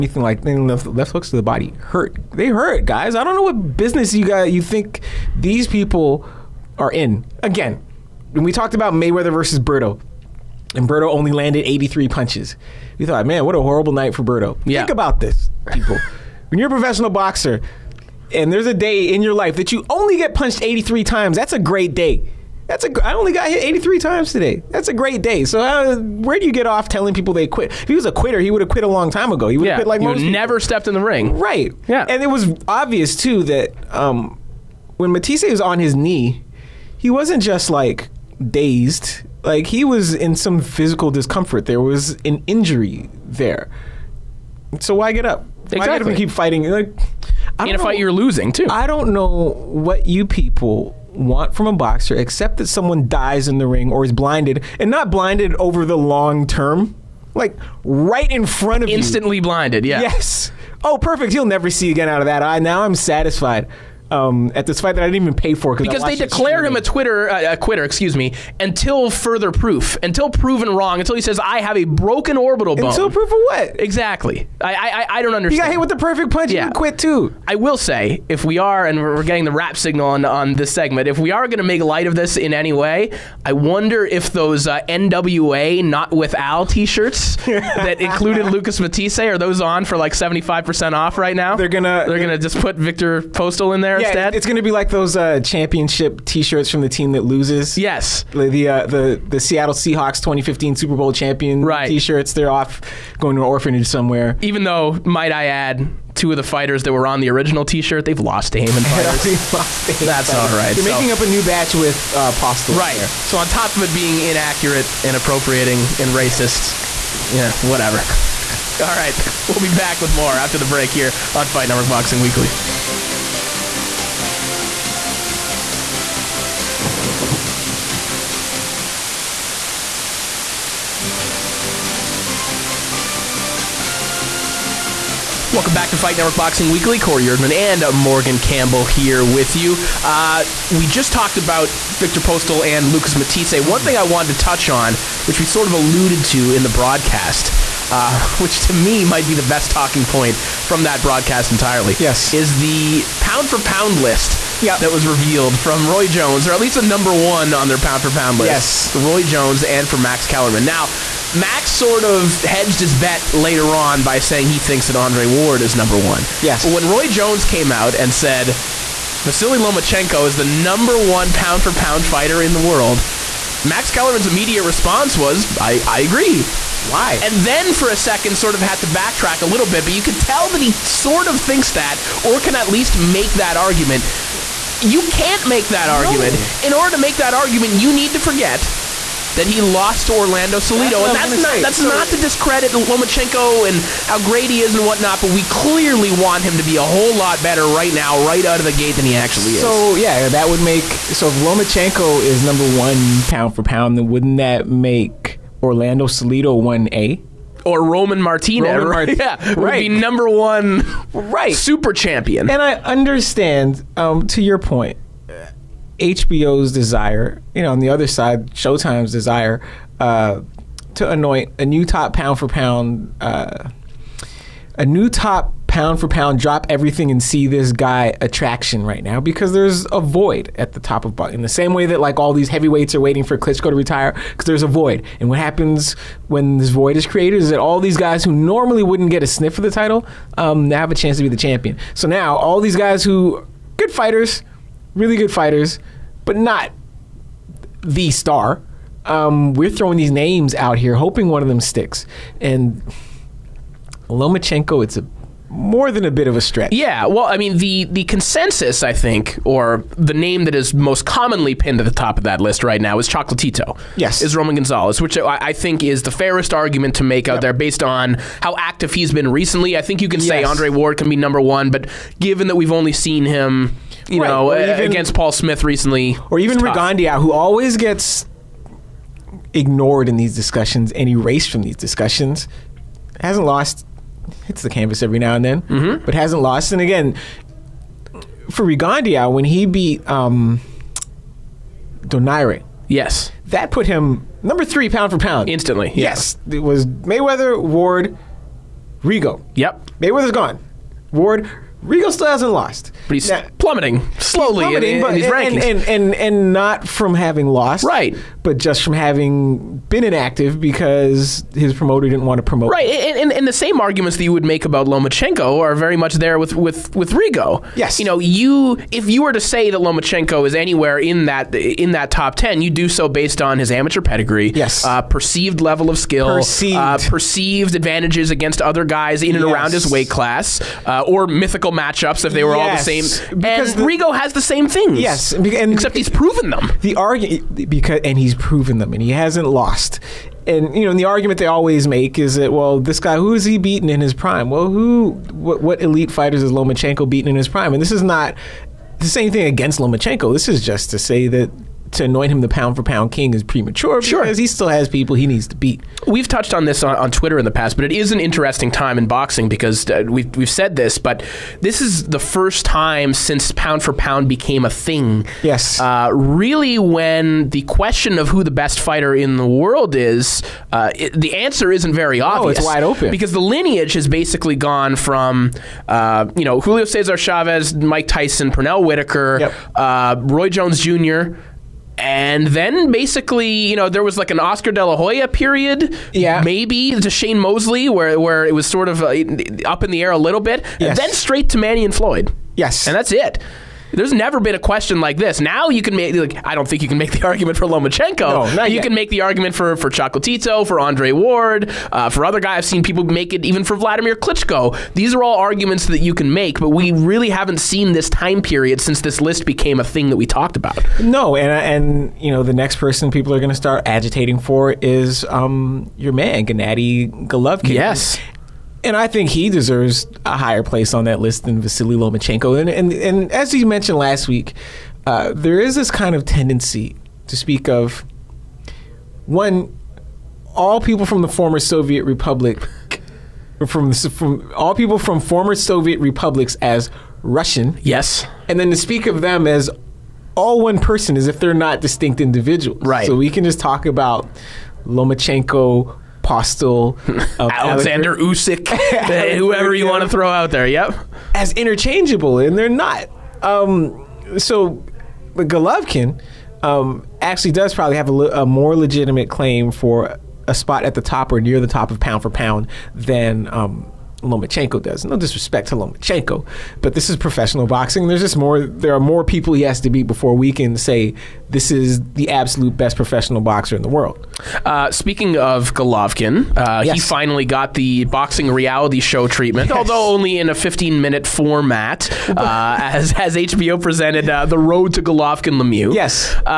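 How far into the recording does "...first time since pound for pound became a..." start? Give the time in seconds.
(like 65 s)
362 s.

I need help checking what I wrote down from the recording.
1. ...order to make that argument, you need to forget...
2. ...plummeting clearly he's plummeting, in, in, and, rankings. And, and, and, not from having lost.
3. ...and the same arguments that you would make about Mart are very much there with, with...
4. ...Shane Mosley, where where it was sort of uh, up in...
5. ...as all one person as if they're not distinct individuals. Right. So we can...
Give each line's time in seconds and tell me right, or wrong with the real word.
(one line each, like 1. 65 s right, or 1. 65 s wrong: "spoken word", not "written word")
1. 186 s right
2. 303 s wrong: "slowly", not "clearly"
3. 313 s wrong: "Lomachenko", not "Mart"
4. 387 s right
5. 439 s right.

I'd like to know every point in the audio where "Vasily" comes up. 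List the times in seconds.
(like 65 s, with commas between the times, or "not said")
169 s, 421 s.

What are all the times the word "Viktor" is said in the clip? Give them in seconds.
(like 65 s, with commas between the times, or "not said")
92 s, 141 s.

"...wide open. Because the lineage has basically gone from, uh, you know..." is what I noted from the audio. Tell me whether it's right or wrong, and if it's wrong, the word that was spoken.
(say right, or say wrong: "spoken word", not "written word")
right.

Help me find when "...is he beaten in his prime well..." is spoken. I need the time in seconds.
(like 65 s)
343 s.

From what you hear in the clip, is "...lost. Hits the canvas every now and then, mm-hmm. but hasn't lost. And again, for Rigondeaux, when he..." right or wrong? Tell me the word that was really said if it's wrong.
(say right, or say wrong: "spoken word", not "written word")
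right.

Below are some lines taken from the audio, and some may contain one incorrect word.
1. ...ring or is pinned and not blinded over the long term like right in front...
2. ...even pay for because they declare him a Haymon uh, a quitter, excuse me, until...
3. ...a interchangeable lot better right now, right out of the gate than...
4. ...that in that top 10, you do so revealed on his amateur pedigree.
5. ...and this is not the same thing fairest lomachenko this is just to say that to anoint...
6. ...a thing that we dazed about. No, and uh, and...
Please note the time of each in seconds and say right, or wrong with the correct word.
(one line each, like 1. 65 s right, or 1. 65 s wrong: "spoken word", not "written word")
1. 53 s wrong: "blinded", not "pinned"
2. 65 s wrong: "Twitter", not "Haymon"
3. 196 s wrong: "whole", not "interchangeable"
4. 321 s wrong: "based", not "revealed"
5. 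347 s wrong: "against", not "fairest"
6. 409 s wrong: "talked", not "dazed".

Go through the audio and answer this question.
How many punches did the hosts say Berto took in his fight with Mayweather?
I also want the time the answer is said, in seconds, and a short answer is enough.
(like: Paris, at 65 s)
83, at 11 s.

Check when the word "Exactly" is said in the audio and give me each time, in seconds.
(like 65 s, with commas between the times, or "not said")
45 s, 73 s.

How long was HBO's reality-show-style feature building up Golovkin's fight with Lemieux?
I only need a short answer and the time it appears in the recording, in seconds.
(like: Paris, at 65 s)
15 minutes, at 480 s.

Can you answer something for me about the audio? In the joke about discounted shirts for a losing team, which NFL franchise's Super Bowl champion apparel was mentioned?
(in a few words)
Seattle Seahawks.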